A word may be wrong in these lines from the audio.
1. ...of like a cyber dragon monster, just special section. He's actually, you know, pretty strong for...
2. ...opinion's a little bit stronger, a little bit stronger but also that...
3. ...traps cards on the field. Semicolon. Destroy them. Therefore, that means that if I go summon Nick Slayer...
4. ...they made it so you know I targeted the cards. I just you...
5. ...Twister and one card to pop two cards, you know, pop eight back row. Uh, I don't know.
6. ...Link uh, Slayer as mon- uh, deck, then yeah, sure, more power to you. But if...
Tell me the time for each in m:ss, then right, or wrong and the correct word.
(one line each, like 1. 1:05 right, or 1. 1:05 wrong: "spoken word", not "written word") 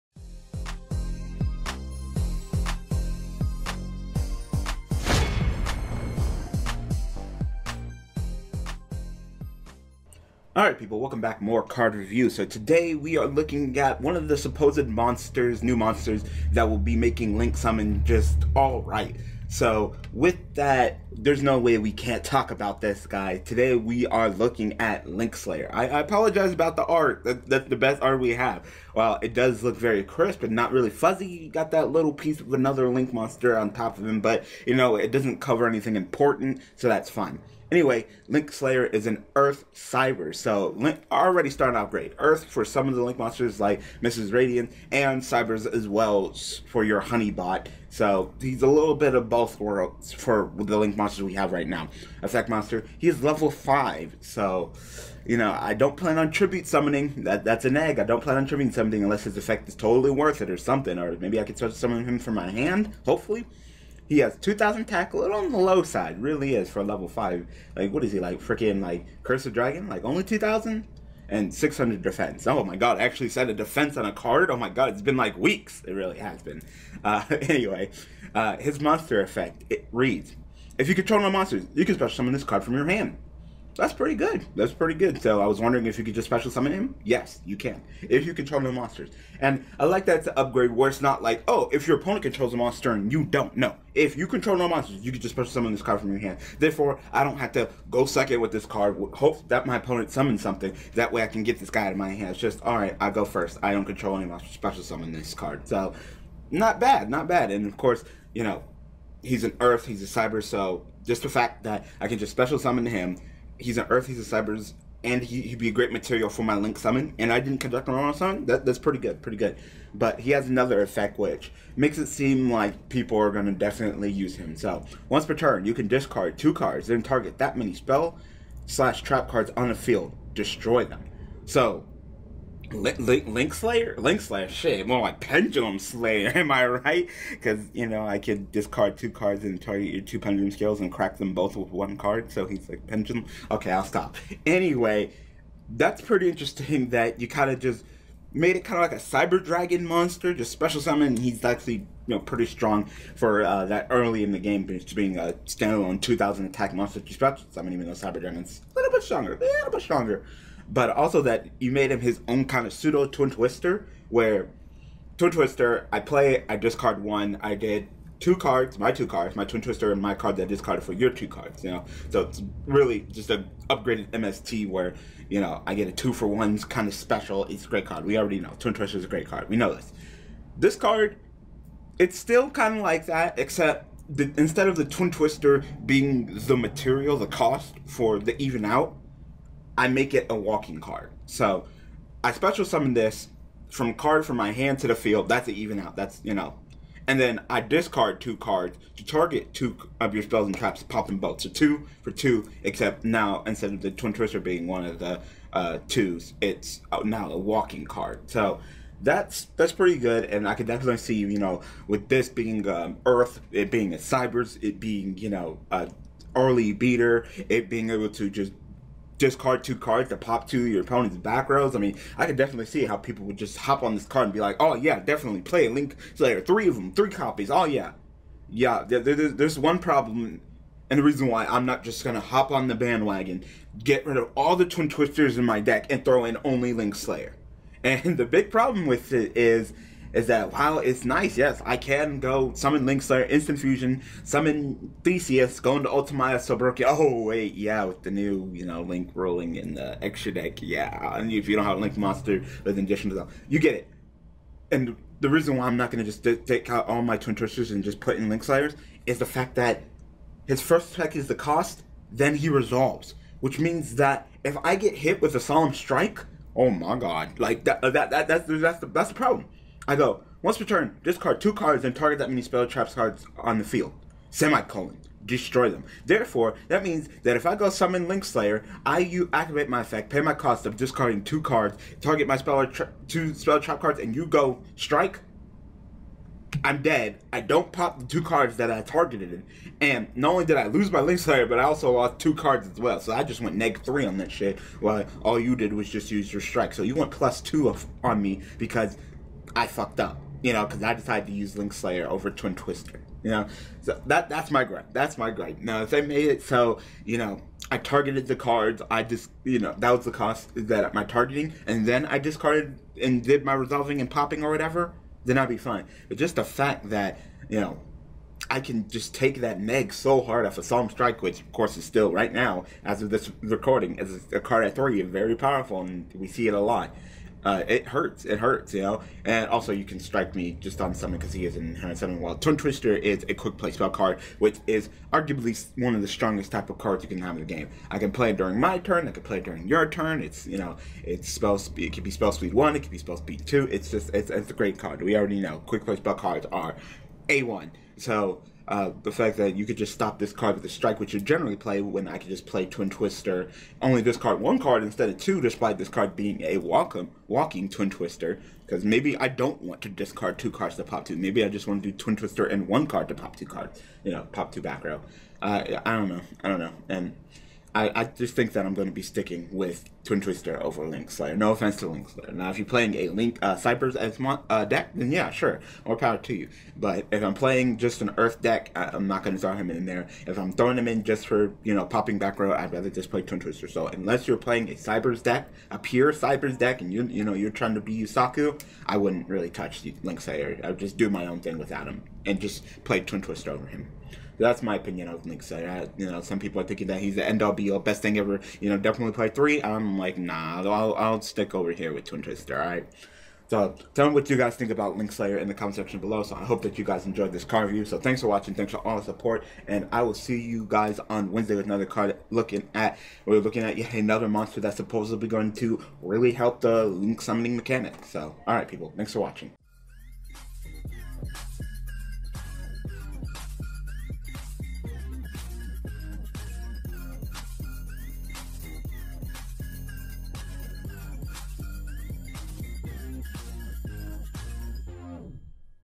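1. 2:28 wrong: "summon", not "section"
2. 2:38 wrong: "dragon", not "opinion"
3. 4:32 wrong: "Link", not "Nick"
4. 5:05 right
5. 6:02 wrong: "two", not "eight"
6. 6:13 wrong: "Cyverse", not "Slayer".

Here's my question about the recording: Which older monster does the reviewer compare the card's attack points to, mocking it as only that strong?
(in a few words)
Curse of Dragon.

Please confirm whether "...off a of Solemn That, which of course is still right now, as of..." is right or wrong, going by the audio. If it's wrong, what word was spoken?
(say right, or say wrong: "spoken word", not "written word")
wrong: "Strike", not "That".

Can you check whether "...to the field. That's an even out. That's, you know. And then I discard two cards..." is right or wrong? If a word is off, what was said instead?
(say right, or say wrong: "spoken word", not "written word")
right.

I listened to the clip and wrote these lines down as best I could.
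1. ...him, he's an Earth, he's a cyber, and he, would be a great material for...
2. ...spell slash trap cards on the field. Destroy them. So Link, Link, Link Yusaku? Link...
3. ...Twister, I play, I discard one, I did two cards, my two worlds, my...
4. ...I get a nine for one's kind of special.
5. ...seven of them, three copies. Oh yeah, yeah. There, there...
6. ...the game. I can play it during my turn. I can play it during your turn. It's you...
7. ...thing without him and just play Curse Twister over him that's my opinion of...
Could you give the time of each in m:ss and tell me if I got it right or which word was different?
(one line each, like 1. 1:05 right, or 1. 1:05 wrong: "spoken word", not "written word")
1. 1:52 right
2. 2:07 wrong: "Slayer", not "Yusaku"
3. 2:45 wrong: "cards", not "worlds"
4. 2:55 wrong: "two", not "nine"
5. 3:46 wrong: "three", not "seven"
6. 5:37 right
7. 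6:31 wrong: "Twin", not "Curse".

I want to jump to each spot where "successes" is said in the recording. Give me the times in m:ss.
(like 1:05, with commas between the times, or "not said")
not said.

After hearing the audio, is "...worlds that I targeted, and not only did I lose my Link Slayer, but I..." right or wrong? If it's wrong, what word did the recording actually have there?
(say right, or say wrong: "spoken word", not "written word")
wrong: "cards", not "worlds".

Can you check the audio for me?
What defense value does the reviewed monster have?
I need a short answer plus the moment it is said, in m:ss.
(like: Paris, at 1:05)
600, at 1:11.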